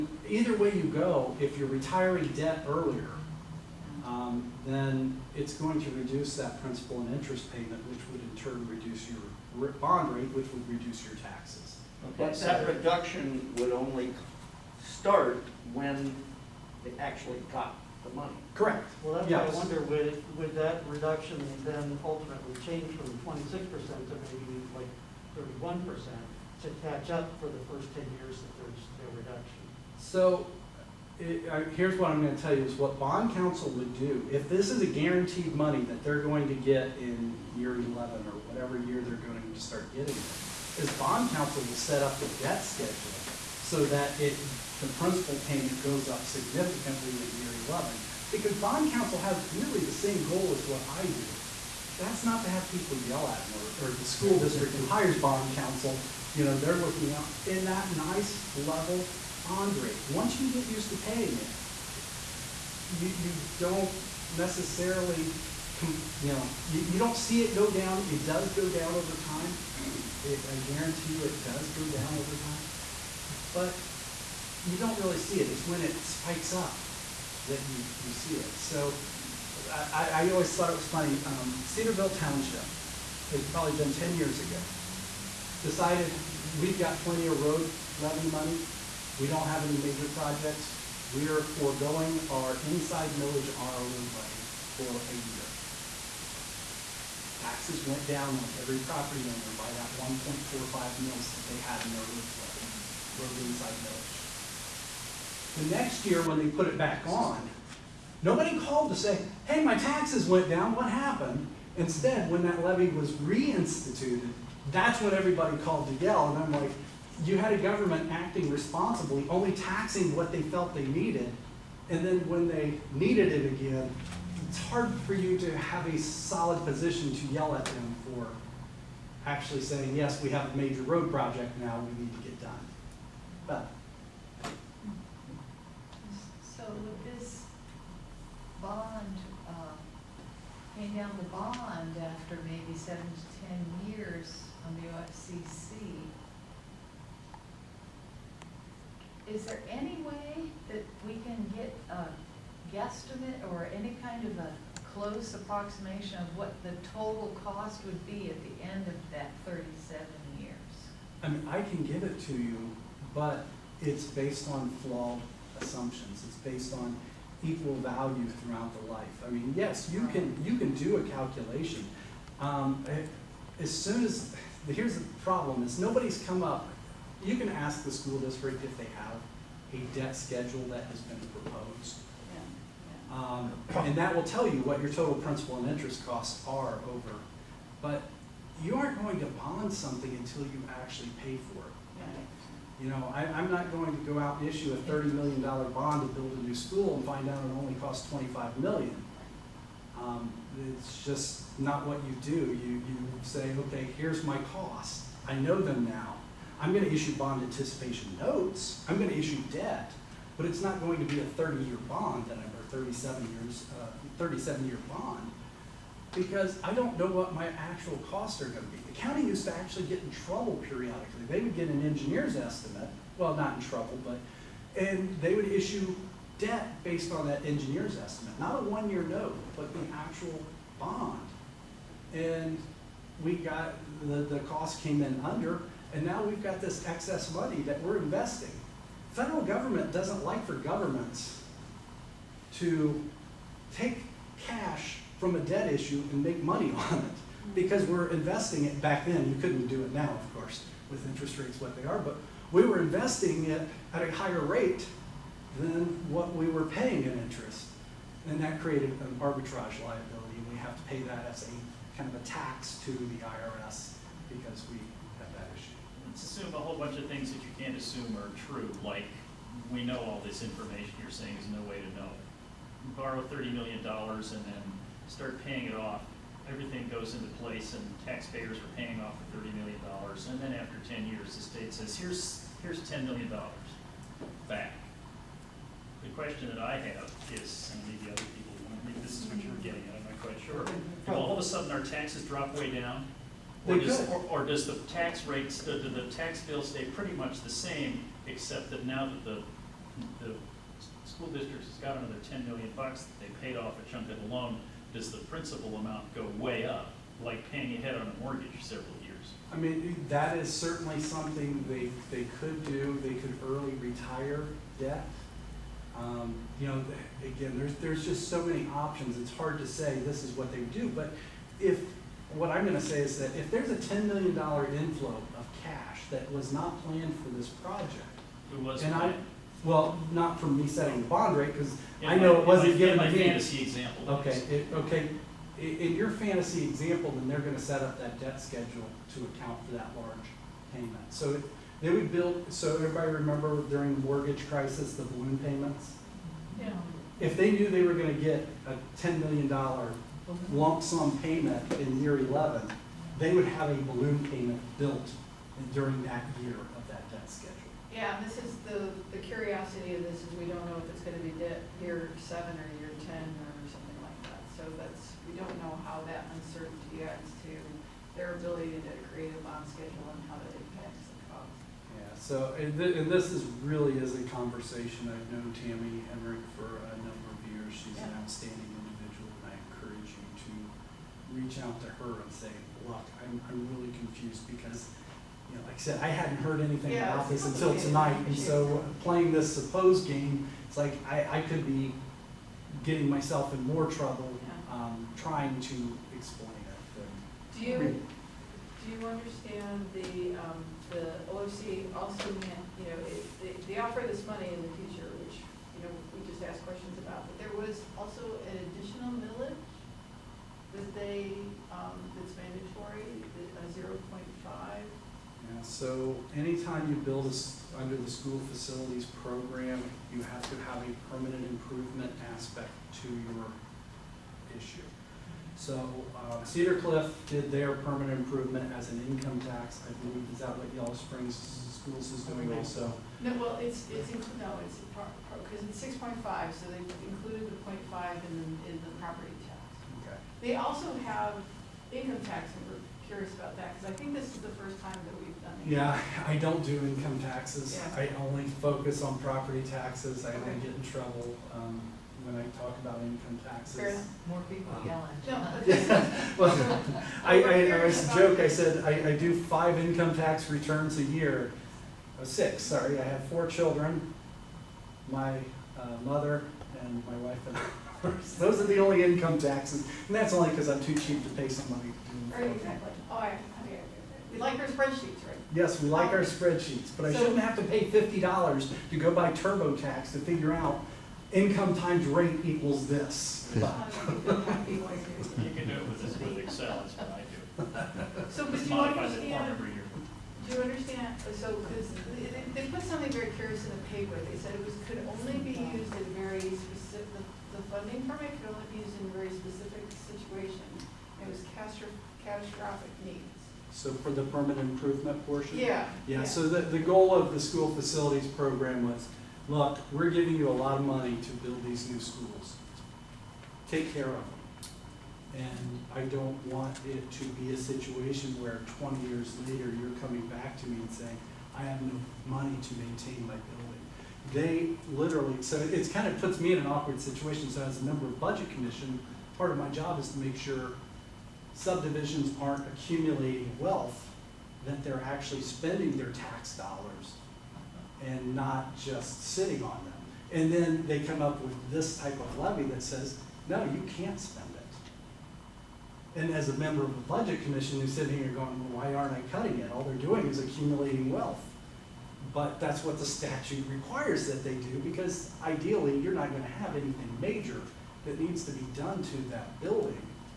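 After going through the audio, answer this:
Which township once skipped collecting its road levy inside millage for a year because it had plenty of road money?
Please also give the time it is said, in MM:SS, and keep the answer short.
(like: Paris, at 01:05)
Cedarville Township, at 01:21.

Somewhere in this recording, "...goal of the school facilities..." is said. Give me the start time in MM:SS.
08:26.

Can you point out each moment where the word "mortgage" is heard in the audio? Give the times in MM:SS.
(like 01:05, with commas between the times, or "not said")
05:08, 05:44.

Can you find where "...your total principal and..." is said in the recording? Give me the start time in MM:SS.
03:04.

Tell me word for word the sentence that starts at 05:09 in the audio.
I mean, that is certainly something they, they could do, they could early retire debt.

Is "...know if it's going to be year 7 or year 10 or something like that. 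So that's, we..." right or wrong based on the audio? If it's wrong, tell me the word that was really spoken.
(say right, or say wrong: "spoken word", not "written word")
right.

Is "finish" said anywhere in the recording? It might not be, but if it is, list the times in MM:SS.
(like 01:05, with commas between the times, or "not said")
not said.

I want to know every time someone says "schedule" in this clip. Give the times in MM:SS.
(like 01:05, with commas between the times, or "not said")
00:42, 03:00, 05:38, 05:57, 06:09.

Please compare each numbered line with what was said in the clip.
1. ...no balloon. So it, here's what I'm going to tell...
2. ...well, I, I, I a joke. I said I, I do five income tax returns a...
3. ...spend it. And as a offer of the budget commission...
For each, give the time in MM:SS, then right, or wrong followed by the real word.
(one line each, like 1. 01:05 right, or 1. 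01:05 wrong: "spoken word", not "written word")
1. 00:28 wrong: "reduction", not "balloon"
2. 07:36 right
3. 09:04 wrong: "member", not "offer".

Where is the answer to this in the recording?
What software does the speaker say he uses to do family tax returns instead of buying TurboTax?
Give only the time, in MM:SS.
08:06.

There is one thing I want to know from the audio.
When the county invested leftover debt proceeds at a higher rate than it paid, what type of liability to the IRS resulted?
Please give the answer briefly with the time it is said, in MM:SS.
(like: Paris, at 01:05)
arbitrage liability, at 04:19.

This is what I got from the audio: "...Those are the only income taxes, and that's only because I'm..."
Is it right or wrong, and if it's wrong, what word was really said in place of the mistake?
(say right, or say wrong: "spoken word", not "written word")
right.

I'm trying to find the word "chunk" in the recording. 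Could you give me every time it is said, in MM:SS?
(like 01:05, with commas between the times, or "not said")
05:03.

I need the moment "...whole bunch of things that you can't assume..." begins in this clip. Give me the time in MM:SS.
04:26.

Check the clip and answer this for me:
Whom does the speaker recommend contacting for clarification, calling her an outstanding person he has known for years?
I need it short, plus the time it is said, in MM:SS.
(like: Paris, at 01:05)
Tammy Emmerich, at 06:15.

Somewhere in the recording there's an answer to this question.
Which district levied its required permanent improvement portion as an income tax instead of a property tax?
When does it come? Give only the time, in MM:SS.
07:06.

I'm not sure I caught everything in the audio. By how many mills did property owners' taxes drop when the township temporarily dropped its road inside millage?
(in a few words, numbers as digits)
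1.45.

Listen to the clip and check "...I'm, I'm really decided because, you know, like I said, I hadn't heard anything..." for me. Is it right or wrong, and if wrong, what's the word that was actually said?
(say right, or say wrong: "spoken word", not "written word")
wrong: "confused", not "decided".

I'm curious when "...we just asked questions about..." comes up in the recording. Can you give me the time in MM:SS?
06:46.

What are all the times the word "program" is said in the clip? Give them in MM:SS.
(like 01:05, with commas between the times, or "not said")
06:59, 08:28.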